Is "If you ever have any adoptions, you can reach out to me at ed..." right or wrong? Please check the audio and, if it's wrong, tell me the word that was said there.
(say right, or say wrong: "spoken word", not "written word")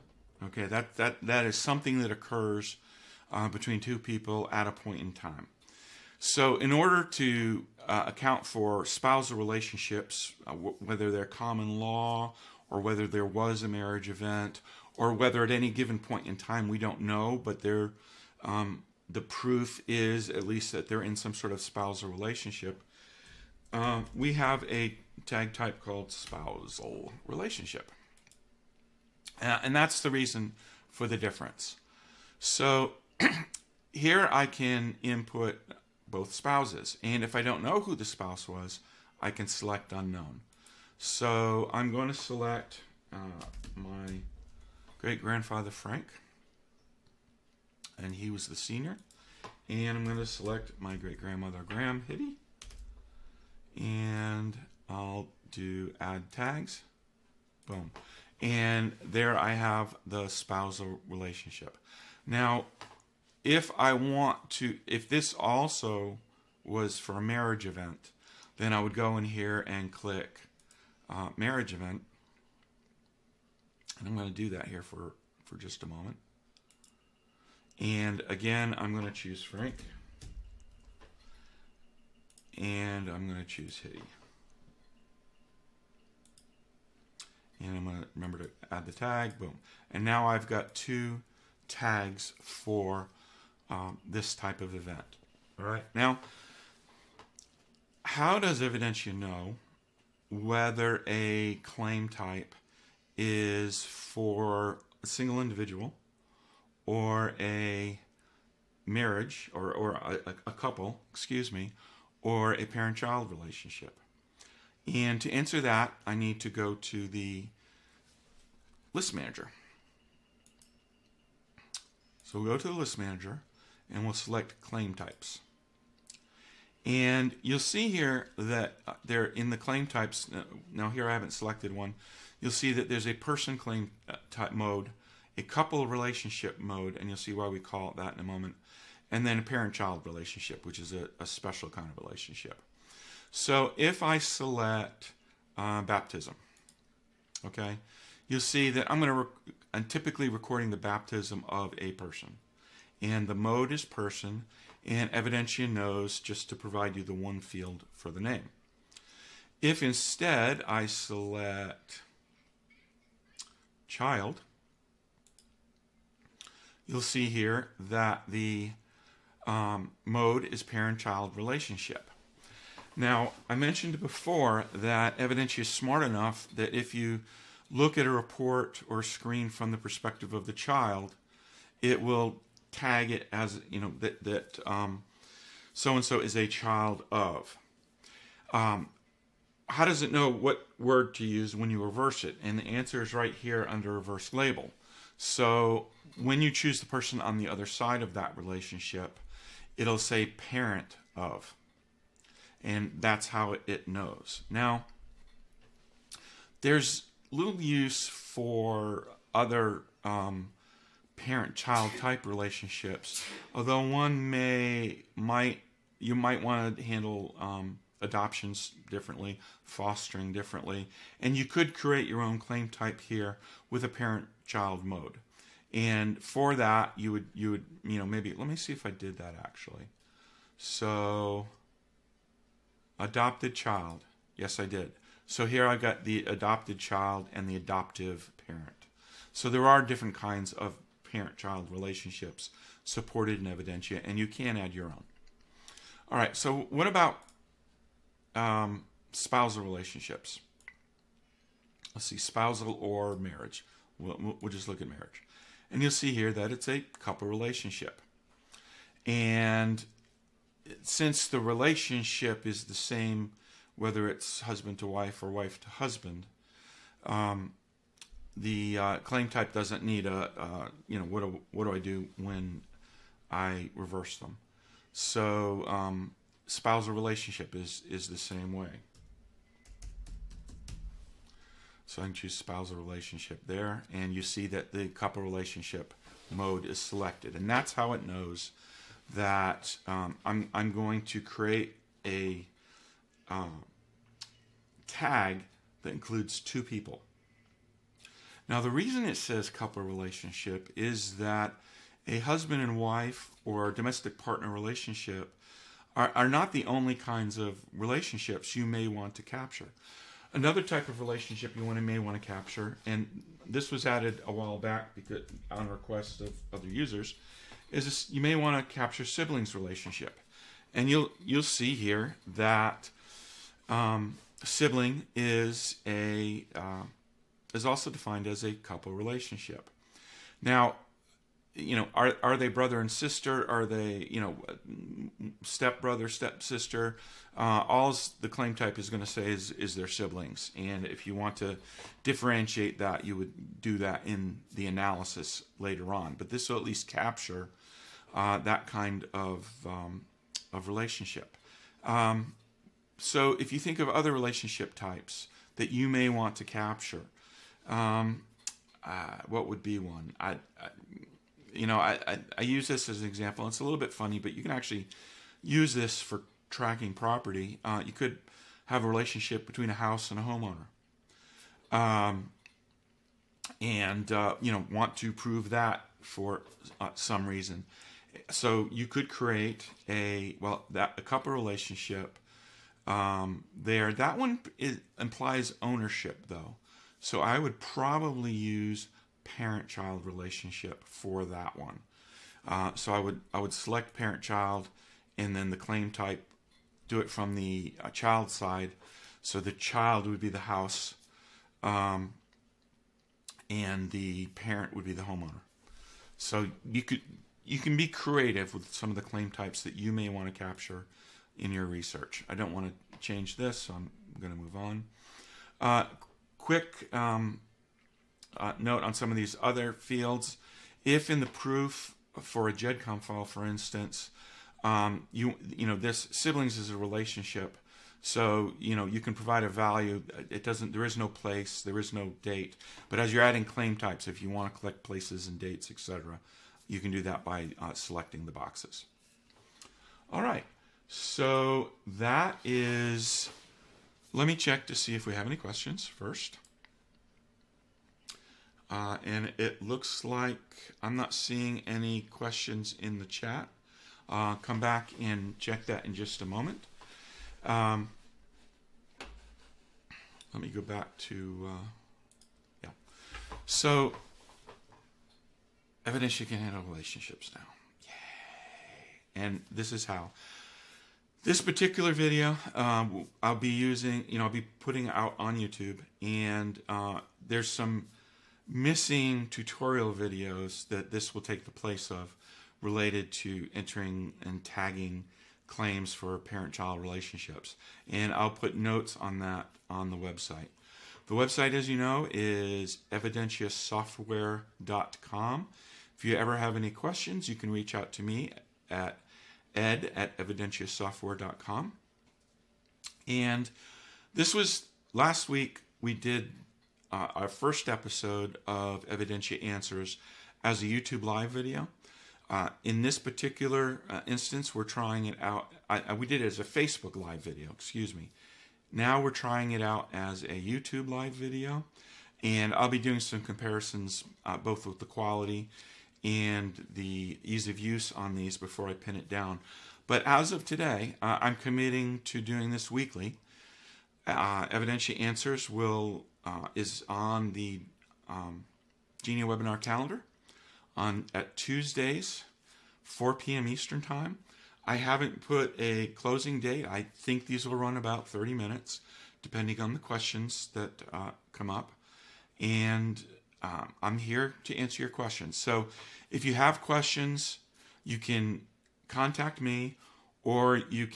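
wrong: "questions", not "adoptions".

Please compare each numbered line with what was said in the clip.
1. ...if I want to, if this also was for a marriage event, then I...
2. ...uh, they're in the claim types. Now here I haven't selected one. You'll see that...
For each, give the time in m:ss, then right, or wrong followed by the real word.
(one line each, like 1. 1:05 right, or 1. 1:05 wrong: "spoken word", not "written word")
1. 1:03 right
2. 2:08 right.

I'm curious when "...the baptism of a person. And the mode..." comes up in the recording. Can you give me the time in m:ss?
2:30.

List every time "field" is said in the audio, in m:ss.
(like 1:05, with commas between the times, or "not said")
2:37, 6:59.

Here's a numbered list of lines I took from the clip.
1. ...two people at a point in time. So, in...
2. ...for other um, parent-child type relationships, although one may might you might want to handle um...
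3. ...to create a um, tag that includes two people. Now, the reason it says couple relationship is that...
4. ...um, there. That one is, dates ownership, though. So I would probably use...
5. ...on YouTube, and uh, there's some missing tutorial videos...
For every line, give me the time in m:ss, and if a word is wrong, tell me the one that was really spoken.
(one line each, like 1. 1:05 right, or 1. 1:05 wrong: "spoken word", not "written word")
1. 0:03 right
2. 3:28 right
3. 4:51 right
4. 6:22 wrong: "implies", not "dates"
5. 7:55 right.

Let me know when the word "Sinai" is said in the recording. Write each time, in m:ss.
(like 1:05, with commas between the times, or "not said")
not said.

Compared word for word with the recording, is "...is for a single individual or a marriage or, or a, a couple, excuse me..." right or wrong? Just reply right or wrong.
right.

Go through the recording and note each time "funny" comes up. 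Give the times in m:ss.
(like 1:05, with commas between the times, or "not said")
6:03.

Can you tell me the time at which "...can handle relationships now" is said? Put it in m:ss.
7:46.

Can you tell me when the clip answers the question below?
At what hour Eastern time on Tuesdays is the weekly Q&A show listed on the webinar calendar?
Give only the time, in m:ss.
9:02.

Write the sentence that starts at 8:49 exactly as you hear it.
But as of today, uh, I'm committing to doing this weekly.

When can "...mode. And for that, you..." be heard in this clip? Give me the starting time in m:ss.
3:44.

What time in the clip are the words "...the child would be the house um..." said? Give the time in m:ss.
6:39.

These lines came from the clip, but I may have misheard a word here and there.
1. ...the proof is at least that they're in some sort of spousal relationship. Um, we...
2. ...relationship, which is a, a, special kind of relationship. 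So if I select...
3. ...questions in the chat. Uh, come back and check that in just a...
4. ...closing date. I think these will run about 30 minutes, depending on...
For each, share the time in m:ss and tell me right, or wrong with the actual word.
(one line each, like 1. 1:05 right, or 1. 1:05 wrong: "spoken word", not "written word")
1. 0:19 right
2. 2:20 right
3. 7:32 right
4. 9:05 right.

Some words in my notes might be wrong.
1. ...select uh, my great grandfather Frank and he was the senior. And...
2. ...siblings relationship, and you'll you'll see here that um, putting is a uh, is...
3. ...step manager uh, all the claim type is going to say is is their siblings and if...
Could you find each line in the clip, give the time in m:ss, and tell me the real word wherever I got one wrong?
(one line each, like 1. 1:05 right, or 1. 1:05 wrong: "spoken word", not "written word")
1. 0:42 right
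2. 5:19 wrong: "sibling", not "putting"
3. 5:36 wrong: "sister", not "manager".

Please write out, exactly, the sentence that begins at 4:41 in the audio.
So I can choose spousal relationship there, and you see that the couple relationship mode is selected.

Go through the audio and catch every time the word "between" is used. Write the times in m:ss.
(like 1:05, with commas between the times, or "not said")
0:03, 6:09.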